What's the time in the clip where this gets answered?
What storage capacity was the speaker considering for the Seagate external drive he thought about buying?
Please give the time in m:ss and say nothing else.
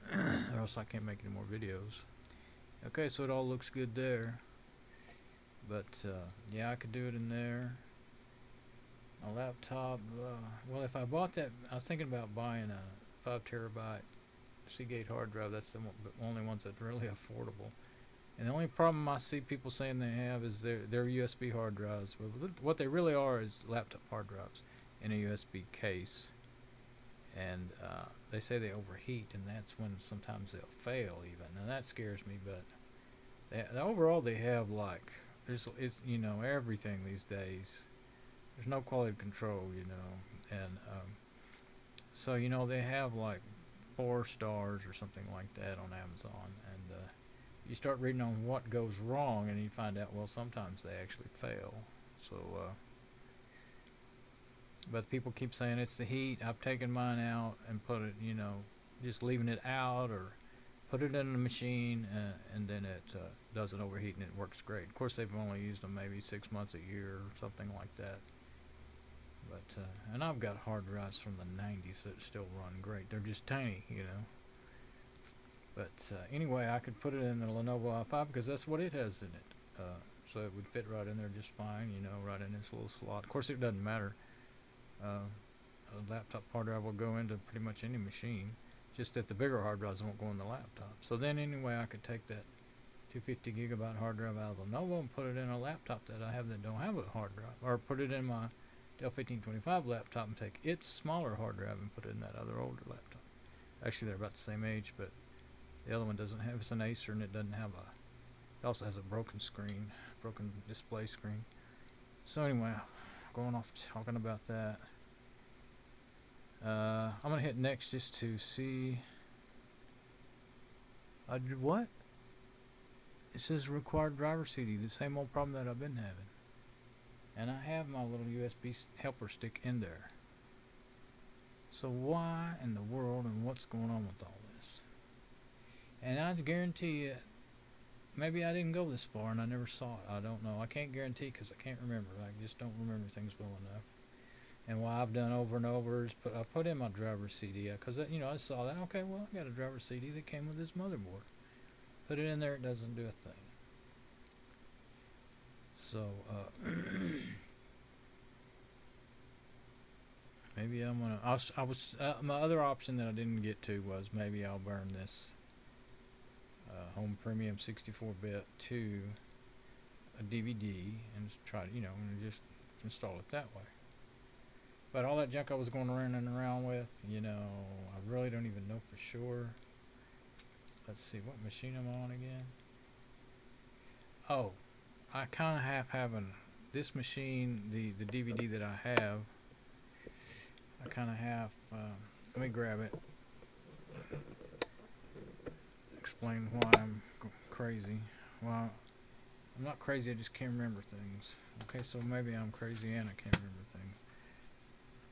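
0:13.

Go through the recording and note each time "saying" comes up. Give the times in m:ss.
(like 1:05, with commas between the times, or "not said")
0:19, 0:55.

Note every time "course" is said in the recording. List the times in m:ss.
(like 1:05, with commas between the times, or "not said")
1:04, 1:23.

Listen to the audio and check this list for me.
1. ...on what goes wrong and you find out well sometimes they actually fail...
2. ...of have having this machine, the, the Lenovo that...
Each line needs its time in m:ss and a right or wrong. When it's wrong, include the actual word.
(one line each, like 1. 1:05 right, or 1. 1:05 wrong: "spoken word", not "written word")
1. 0:48 right
2. 3:05 wrong: "DVD", not "Lenovo".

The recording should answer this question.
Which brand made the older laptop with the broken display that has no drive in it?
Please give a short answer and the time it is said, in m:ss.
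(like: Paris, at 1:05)
Acer, at 1:46.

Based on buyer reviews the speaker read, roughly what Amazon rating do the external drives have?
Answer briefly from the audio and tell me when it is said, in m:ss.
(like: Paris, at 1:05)
4 stars, at 0:43.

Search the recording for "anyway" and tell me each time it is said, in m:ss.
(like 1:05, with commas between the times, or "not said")
1:16, 1:31, 1:52.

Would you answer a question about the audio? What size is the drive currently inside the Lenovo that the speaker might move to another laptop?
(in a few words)
250 gigabyte.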